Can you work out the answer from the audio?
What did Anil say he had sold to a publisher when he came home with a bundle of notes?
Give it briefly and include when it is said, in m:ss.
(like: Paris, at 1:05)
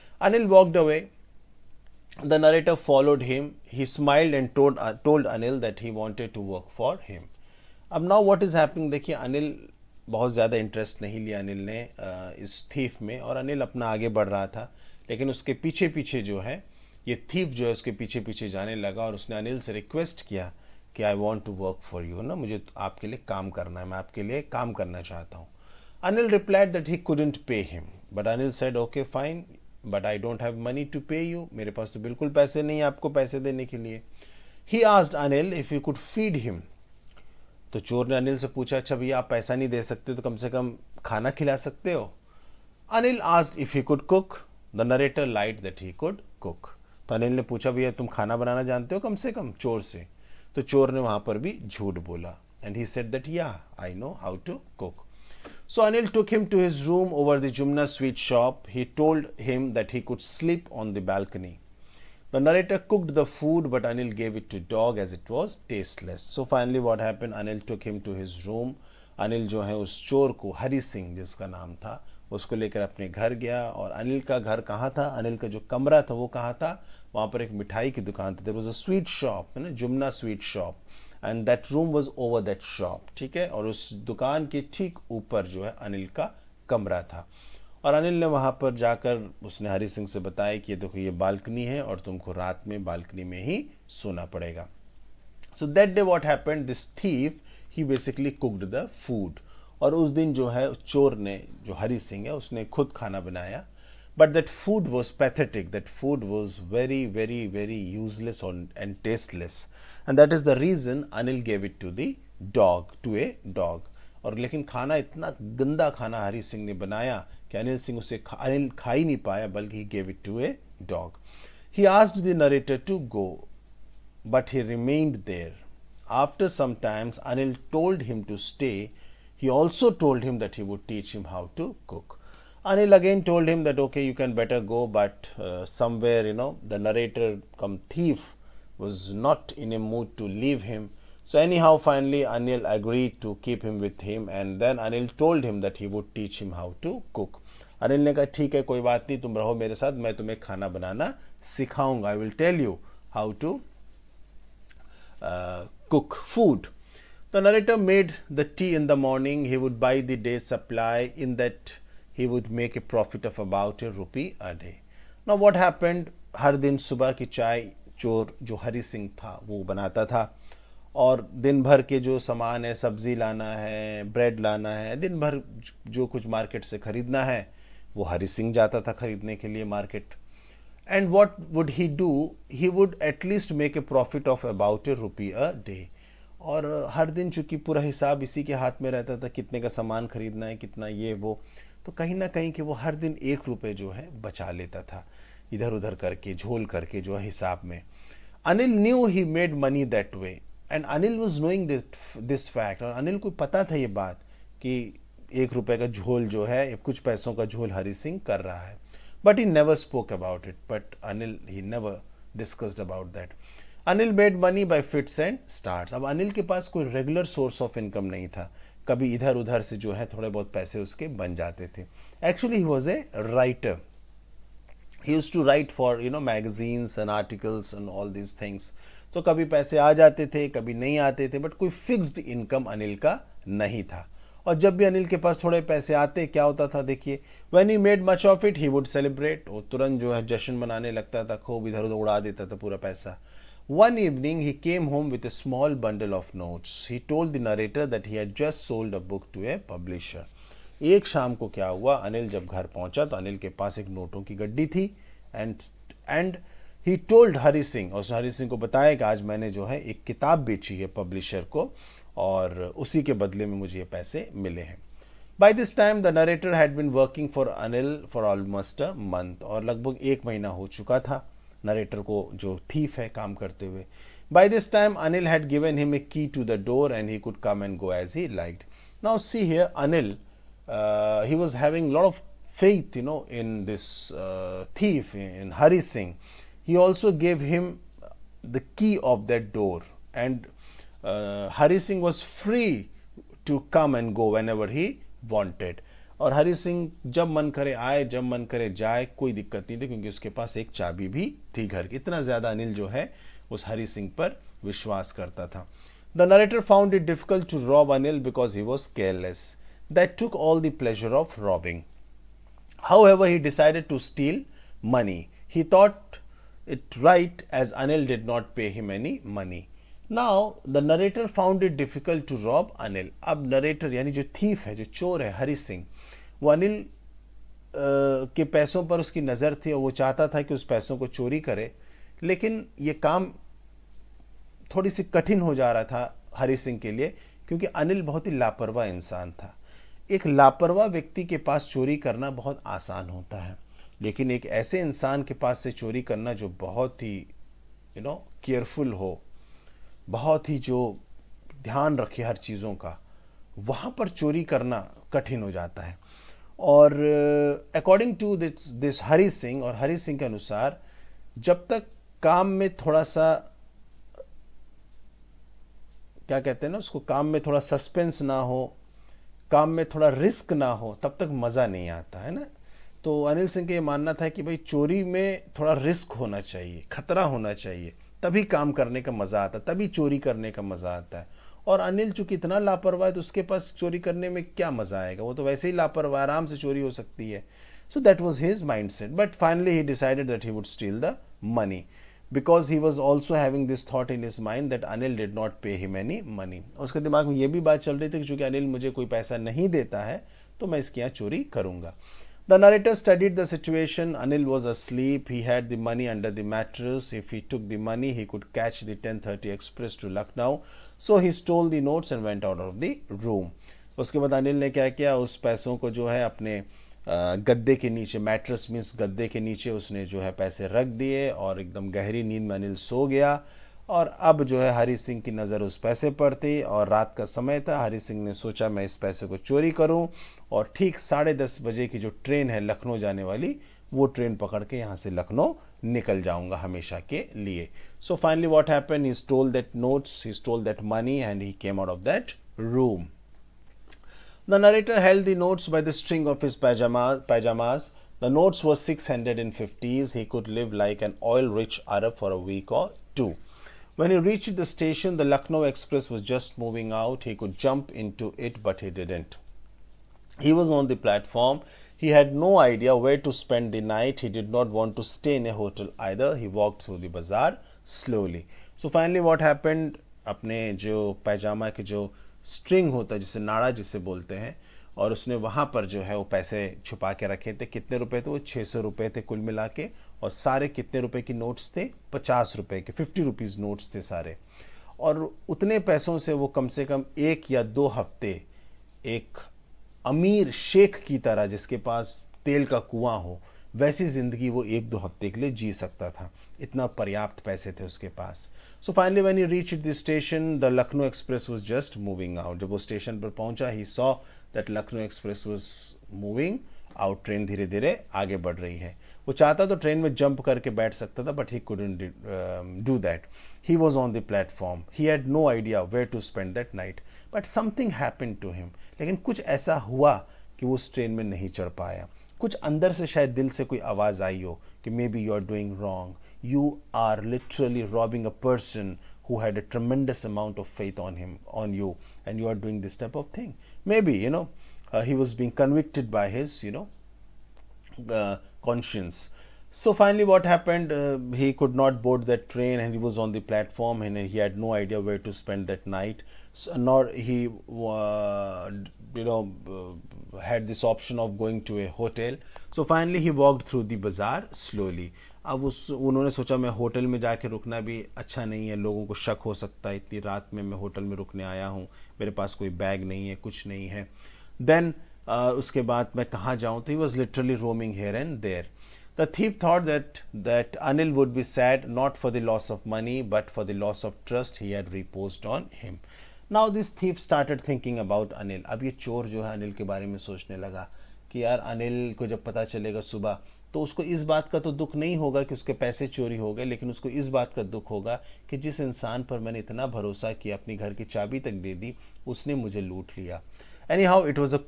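A book, at 4:08.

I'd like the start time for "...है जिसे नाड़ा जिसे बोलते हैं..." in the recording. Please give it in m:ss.
7:53.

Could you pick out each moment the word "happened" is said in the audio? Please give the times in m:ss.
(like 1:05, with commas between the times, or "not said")
1:06, 2:45, 7:49, 9:00.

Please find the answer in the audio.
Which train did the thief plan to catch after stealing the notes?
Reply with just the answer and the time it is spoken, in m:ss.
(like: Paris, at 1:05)
10:30 Express to Lucknow, at 6:49.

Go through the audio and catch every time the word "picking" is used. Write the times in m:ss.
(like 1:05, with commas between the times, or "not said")
not said.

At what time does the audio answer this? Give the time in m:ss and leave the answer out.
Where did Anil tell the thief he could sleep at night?
1:00.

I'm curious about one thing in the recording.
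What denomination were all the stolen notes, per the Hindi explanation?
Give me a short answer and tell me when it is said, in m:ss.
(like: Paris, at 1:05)
50 rupees, at 8:02.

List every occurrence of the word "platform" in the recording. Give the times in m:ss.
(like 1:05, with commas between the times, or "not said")
7:41, 9:03.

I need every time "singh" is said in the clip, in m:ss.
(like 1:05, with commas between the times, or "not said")
4:45, 4:51.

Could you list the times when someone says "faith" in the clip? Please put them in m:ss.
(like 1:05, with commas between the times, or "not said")
4:42, 8:50.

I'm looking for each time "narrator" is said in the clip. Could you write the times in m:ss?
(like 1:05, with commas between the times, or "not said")
0:02, 1:02, 2:16, 2:37, 4:07, 4:31, 7:24.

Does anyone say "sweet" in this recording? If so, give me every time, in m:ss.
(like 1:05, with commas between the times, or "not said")
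0:57.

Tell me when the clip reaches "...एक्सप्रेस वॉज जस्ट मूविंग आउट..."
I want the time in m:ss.
8:21.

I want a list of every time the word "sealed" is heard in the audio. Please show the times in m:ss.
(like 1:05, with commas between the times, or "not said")
not said.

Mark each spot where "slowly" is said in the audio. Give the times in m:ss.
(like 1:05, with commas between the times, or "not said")
7:47, 9:14.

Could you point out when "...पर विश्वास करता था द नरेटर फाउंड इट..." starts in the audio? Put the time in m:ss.
5:04.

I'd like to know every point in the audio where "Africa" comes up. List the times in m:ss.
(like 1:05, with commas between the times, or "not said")
not said.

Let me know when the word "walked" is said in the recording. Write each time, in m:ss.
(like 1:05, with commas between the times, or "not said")
0:00, 7:46, 9:13.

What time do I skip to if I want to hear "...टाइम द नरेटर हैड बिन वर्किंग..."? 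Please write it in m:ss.
4:25.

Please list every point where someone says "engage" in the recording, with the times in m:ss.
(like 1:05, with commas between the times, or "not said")
not said.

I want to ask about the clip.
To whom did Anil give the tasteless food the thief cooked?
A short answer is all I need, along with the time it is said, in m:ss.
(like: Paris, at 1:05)
A dog, at 1:53.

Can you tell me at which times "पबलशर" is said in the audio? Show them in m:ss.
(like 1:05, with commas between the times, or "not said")
4:21.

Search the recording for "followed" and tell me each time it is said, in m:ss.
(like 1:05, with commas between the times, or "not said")
0:02.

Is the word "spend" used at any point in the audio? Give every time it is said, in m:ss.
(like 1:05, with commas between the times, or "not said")
7:43, 9:05.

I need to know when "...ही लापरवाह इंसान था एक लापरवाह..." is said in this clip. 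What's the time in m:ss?
5:38.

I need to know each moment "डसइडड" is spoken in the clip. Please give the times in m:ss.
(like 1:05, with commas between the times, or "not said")
5:13, 6:29.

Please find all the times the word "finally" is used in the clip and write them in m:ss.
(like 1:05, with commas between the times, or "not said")
1:06, 2:21, 7:48, 9:00, 9:12.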